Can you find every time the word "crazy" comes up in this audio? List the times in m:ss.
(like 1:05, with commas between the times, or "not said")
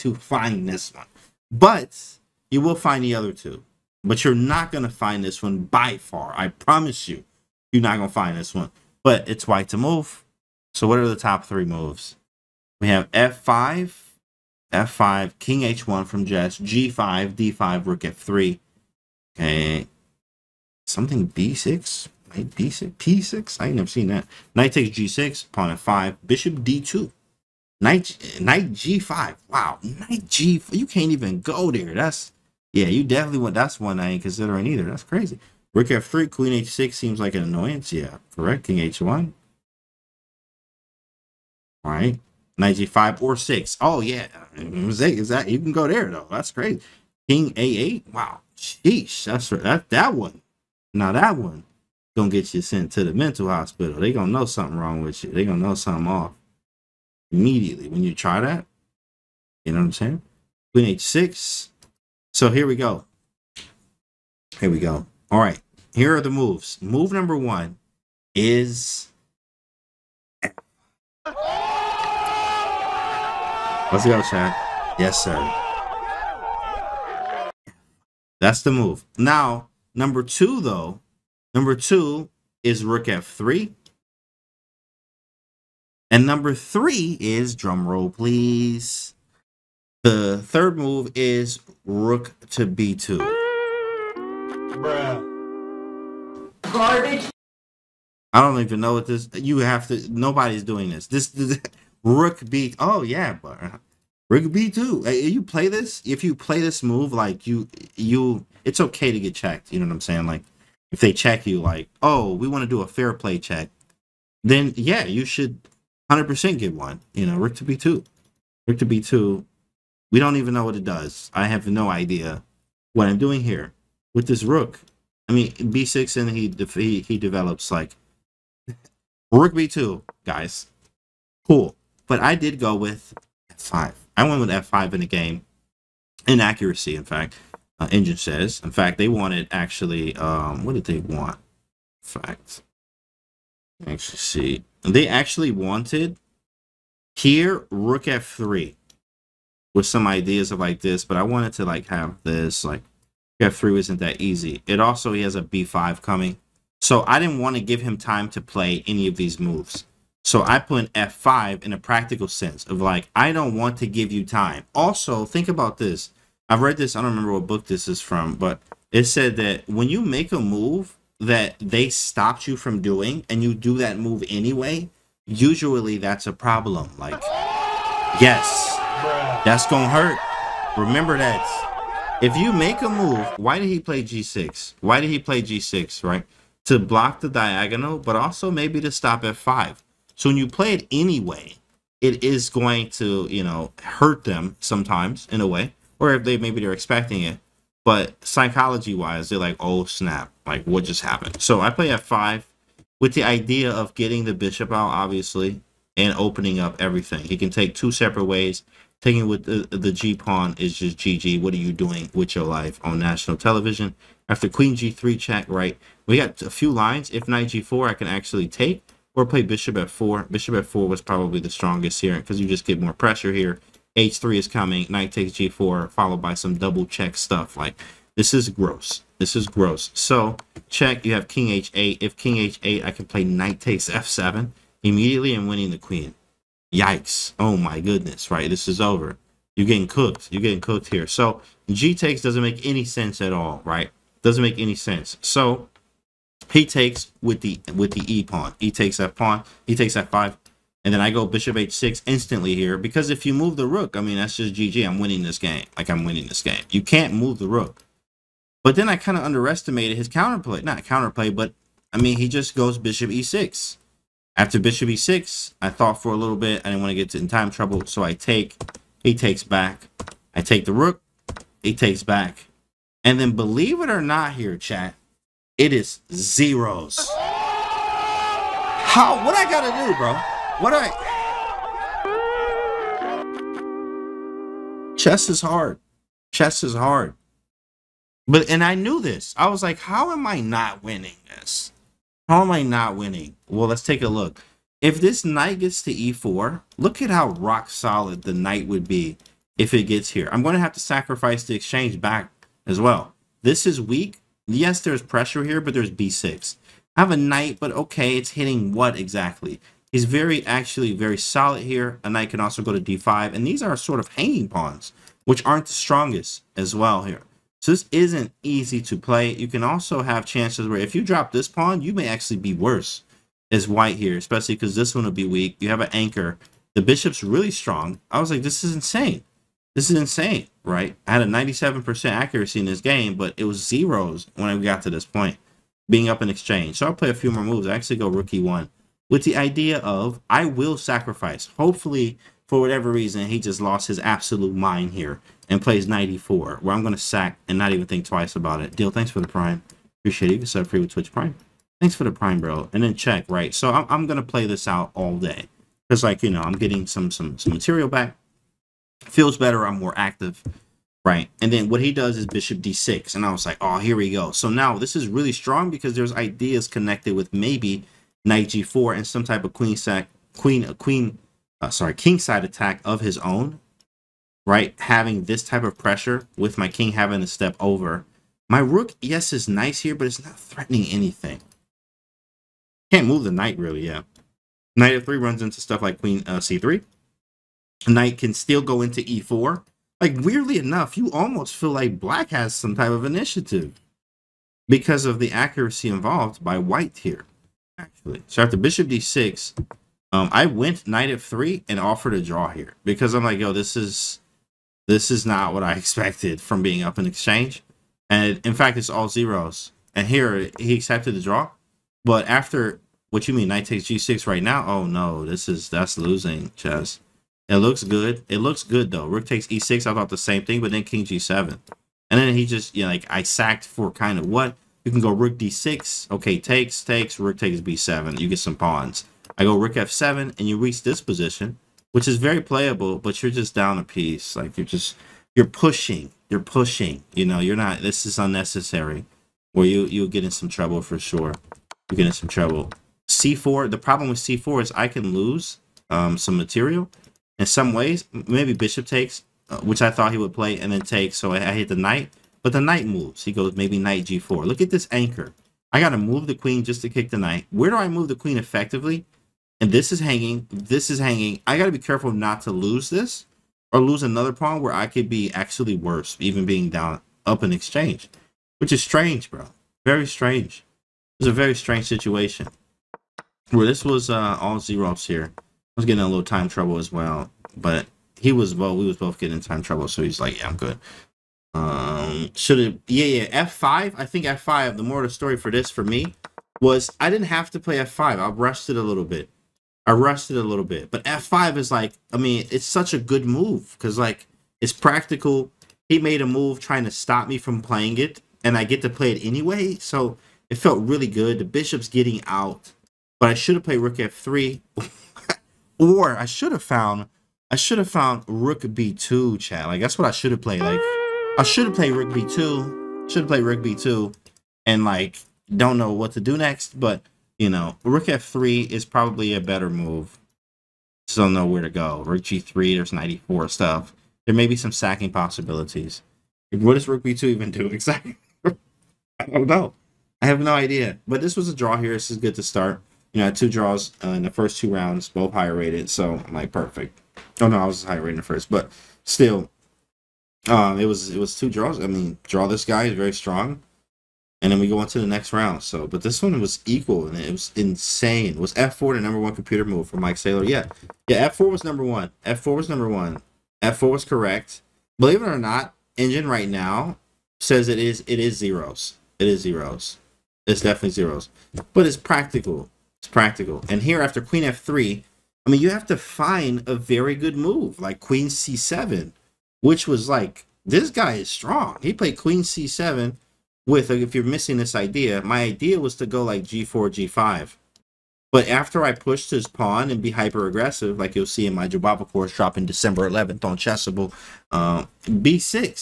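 0:35, 0:46.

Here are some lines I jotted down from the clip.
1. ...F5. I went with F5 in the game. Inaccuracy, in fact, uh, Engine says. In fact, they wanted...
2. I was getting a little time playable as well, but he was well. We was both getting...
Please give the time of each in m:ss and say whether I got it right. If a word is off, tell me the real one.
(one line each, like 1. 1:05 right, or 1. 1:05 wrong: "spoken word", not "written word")
1. 2:13 right
2. 7:55 wrong: "trouble", not "playable".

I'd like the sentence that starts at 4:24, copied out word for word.
After bishop e6, I thought for a little bit.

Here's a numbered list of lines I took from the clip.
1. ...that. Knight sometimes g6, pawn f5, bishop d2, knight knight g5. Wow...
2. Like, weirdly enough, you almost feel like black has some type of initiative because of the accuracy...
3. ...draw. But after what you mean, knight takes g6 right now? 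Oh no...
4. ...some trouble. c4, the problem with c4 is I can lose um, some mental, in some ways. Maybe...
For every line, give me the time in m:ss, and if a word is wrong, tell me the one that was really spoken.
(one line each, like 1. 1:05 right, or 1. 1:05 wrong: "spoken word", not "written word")
1. 0:24 wrong: "takes", not "sometimes"
2. 6:29 right
3. 6:51 right
4. 7:22 wrong: "material", not "mental".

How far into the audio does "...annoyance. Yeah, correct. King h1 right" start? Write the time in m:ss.
0:37.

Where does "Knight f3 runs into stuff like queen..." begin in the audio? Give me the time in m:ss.
6:24.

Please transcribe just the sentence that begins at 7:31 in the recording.
So I, hit the knight, but the knight moves.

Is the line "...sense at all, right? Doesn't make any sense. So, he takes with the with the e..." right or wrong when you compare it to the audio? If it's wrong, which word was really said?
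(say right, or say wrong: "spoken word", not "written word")
right.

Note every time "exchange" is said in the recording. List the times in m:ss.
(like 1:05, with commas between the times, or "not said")
5:01, 5:36, 6:47, 7:47.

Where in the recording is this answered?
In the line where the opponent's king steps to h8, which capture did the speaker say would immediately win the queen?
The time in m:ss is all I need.
3:53.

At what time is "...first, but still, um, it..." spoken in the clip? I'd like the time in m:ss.
8:58.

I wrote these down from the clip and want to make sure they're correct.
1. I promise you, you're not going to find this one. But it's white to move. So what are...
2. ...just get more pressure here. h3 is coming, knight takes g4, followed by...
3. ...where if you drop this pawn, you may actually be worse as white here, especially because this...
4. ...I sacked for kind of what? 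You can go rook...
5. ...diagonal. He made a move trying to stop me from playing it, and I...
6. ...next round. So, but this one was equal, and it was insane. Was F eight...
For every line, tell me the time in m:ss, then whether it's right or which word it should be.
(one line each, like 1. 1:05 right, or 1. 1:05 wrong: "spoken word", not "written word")
1. 0:06 right
2. 3:42 right
3. 5:20 right
4. 7:03 right
5. 8:14 wrong: "practical", not "diagonal"
6. 9:05 wrong: "four", not "eight".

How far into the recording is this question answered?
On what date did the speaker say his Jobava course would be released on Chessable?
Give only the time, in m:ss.
9:42.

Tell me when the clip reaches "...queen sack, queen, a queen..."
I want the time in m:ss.
6:09.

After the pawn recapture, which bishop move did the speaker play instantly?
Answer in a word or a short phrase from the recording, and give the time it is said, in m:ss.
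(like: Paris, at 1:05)
bishop h6, at 4:11.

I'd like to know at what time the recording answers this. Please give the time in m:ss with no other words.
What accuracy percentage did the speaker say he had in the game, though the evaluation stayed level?
5:31.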